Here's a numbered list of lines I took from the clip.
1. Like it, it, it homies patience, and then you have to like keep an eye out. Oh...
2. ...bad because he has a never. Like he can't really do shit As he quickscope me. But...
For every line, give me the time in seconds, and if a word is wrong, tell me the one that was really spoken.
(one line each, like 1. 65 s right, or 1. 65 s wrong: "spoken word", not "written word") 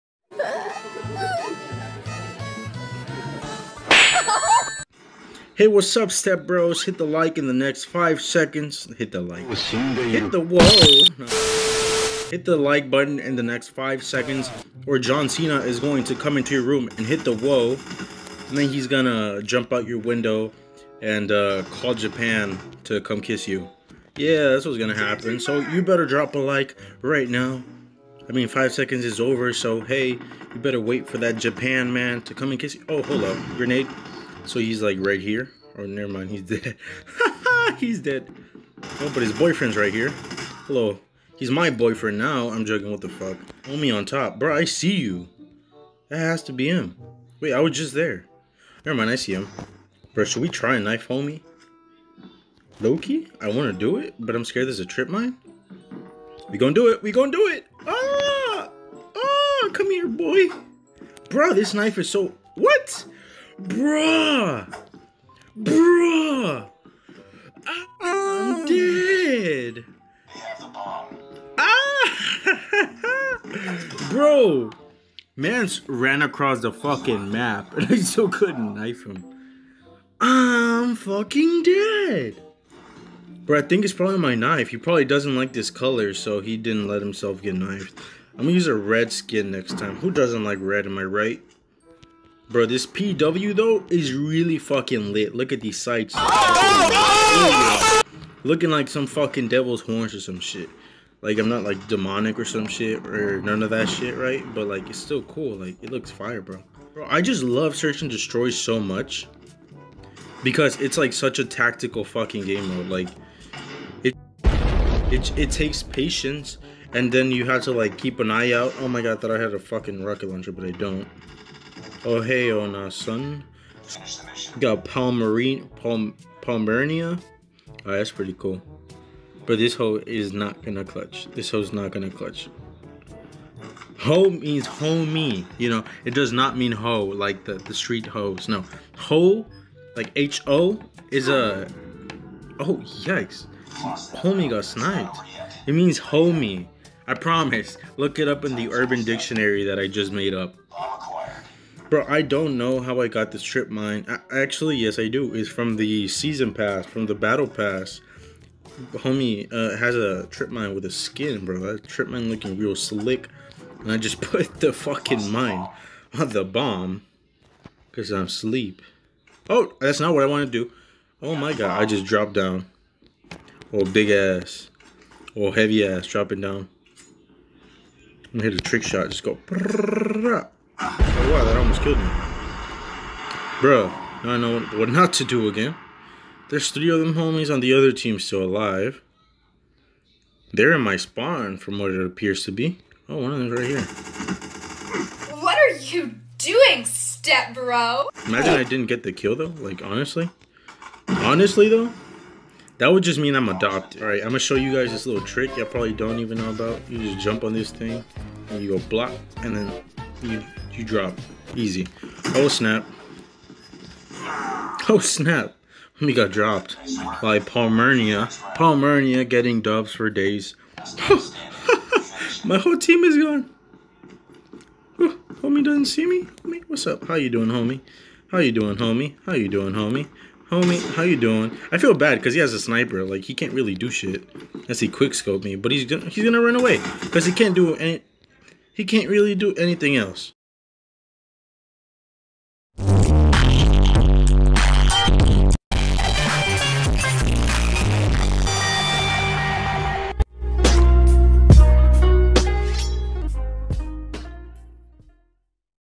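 1. 112 s wrong: "takes", not "homies"
2. 231 s wrong: "sniper", not "never".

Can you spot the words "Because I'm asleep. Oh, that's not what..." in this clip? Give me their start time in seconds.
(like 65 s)
167 s.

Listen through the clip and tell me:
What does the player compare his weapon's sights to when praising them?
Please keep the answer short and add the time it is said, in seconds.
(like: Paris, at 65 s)
devil's horns, at 99 s.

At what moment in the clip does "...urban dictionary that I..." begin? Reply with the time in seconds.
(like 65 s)
148 s.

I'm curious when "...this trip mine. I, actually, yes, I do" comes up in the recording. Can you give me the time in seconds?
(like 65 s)
153 s.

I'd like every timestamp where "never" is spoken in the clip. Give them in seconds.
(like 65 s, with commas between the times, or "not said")
35 s, 48 s.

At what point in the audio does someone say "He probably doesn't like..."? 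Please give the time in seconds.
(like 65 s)
84 s.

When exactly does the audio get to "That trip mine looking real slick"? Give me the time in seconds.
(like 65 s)
161 s.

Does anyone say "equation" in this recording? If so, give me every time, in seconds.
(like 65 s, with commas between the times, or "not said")
not said.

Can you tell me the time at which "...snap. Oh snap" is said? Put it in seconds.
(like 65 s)
212 s.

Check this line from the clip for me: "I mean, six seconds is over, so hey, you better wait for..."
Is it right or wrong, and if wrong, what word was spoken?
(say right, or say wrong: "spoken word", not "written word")
wrong: "five", not "six".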